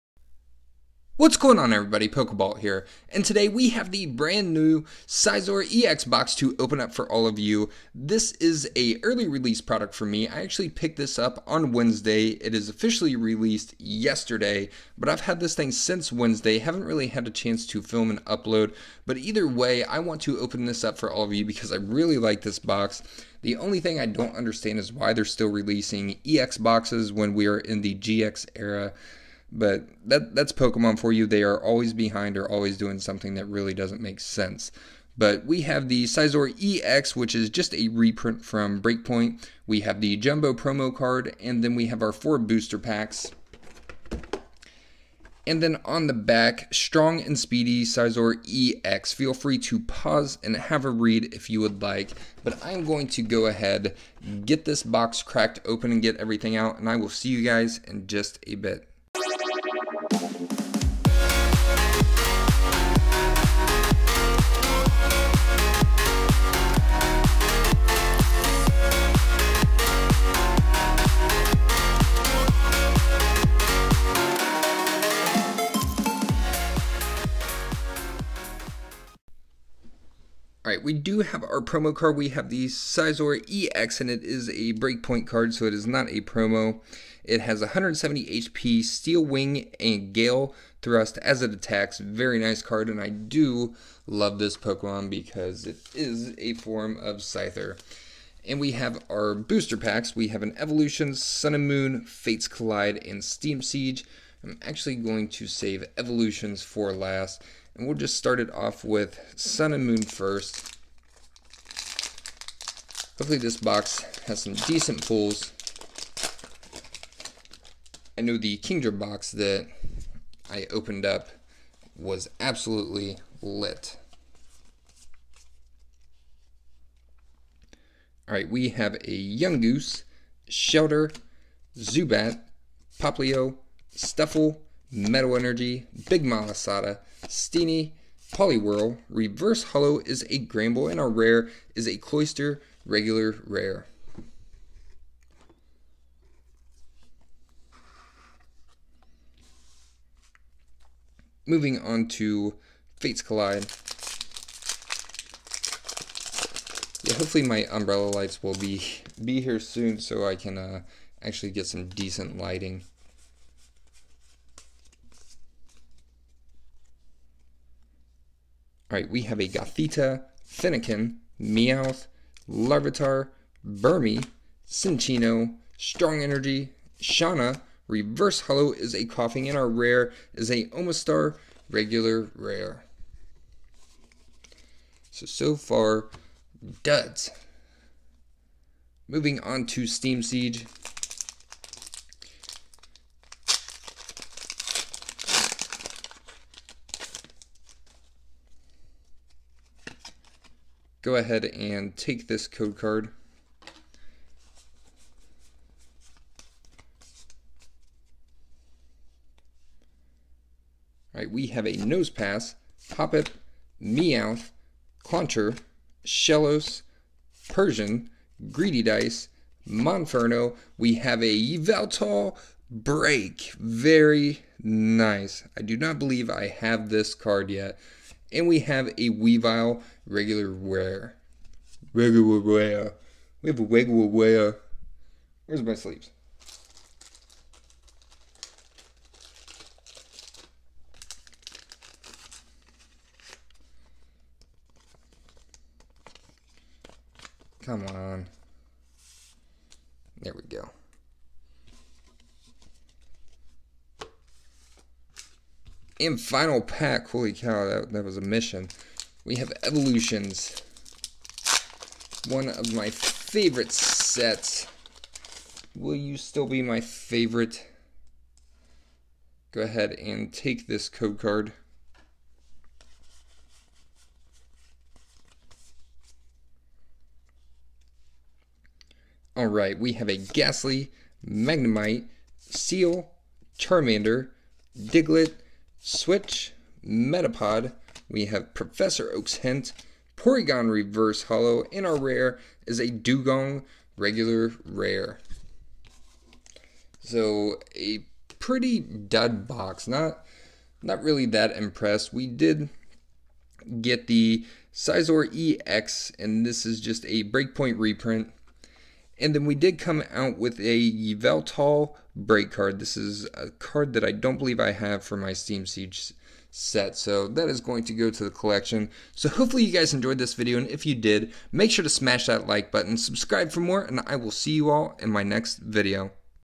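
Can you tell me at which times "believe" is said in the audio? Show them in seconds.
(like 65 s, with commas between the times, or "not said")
225 s, 314 s.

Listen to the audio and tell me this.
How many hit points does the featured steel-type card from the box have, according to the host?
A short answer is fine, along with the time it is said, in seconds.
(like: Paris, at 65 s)
170, at 87 s.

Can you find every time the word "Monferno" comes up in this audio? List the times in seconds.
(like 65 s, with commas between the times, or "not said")
219 s.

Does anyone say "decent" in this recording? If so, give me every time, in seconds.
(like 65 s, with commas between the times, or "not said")
114 s, 161 s.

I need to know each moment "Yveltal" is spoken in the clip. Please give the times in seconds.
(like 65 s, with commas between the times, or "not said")
221 s, 310 s.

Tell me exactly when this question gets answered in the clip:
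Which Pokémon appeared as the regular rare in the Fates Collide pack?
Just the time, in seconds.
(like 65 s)
180 s.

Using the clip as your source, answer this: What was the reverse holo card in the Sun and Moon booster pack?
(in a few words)
Gramble.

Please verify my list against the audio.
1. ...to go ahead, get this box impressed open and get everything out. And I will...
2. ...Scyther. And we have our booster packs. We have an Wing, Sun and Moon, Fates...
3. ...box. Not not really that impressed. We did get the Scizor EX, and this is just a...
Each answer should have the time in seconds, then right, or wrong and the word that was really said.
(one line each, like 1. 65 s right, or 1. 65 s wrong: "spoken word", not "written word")
1. 53 s wrong: "cracked", not "impressed"
2. 97 s wrong: "Evolution", not "Wing"
3. 299 s right.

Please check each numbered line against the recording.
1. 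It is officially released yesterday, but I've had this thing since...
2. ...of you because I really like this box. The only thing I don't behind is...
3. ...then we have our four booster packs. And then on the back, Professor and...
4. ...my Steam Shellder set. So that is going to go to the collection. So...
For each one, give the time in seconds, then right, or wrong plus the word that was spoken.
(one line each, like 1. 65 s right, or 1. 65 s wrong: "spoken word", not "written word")
1. 12 s right
2. 21 s wrong: "understand", not "behind"
3. 41 s wrong: "Strong", not "Professor"
4. 315 s wrong: "Siege", not "Shellder".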